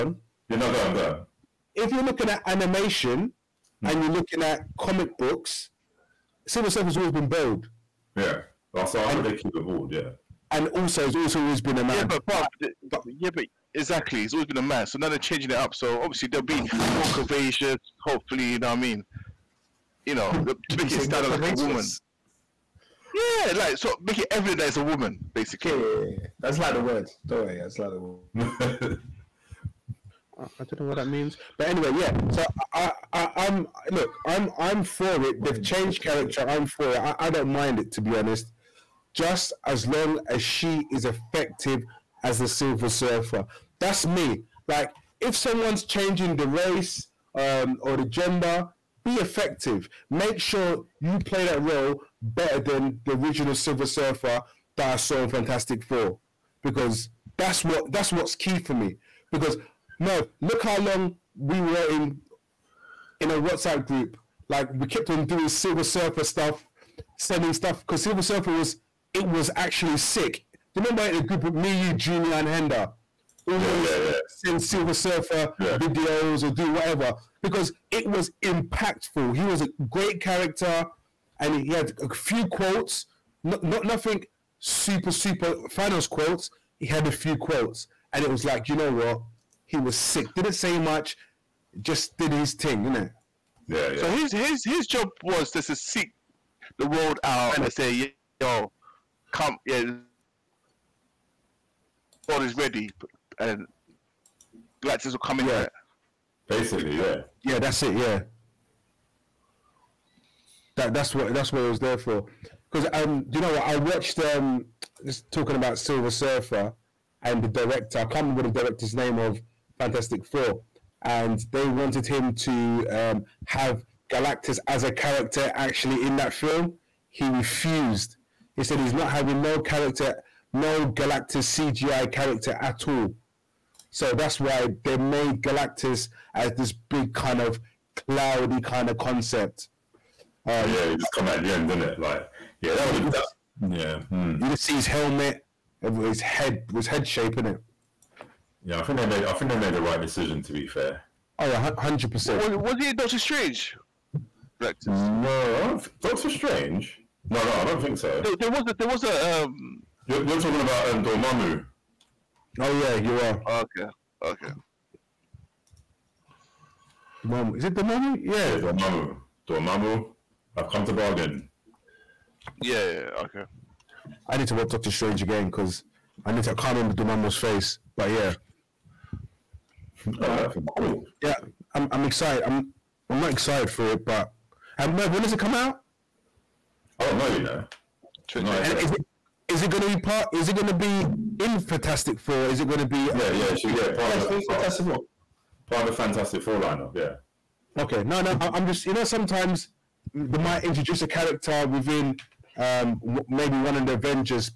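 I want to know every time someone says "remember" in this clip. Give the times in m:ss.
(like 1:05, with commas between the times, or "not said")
1:10, 1:58, 2:56.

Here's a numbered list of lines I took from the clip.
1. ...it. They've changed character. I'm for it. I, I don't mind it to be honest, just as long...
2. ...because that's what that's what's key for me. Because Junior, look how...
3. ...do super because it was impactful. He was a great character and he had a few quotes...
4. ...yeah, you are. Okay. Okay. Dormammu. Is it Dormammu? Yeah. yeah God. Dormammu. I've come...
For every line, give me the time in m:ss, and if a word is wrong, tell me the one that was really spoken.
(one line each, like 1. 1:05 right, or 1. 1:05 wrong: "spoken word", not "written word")
1. 0:35 right
2. 0:56 wrong: "Merv", not "Junior"
3. 1:16 wrong: "whatever", not "super"
4. 2:42 wrong: "Dormammu", not "God".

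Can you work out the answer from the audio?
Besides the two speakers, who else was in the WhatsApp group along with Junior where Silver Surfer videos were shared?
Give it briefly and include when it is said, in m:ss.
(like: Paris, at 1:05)
Henda, at 1:12.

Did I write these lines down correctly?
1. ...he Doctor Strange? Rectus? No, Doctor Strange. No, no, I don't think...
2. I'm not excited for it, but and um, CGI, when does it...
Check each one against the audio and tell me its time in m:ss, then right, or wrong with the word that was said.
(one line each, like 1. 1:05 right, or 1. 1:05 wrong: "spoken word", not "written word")
1. 2:32 right
2. 3:03 wrong: "Merv", not "CGI".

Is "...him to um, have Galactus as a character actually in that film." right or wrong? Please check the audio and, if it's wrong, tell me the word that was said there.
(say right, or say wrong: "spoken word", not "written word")
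right.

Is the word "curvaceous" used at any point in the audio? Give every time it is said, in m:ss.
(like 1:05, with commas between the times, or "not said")
0:17.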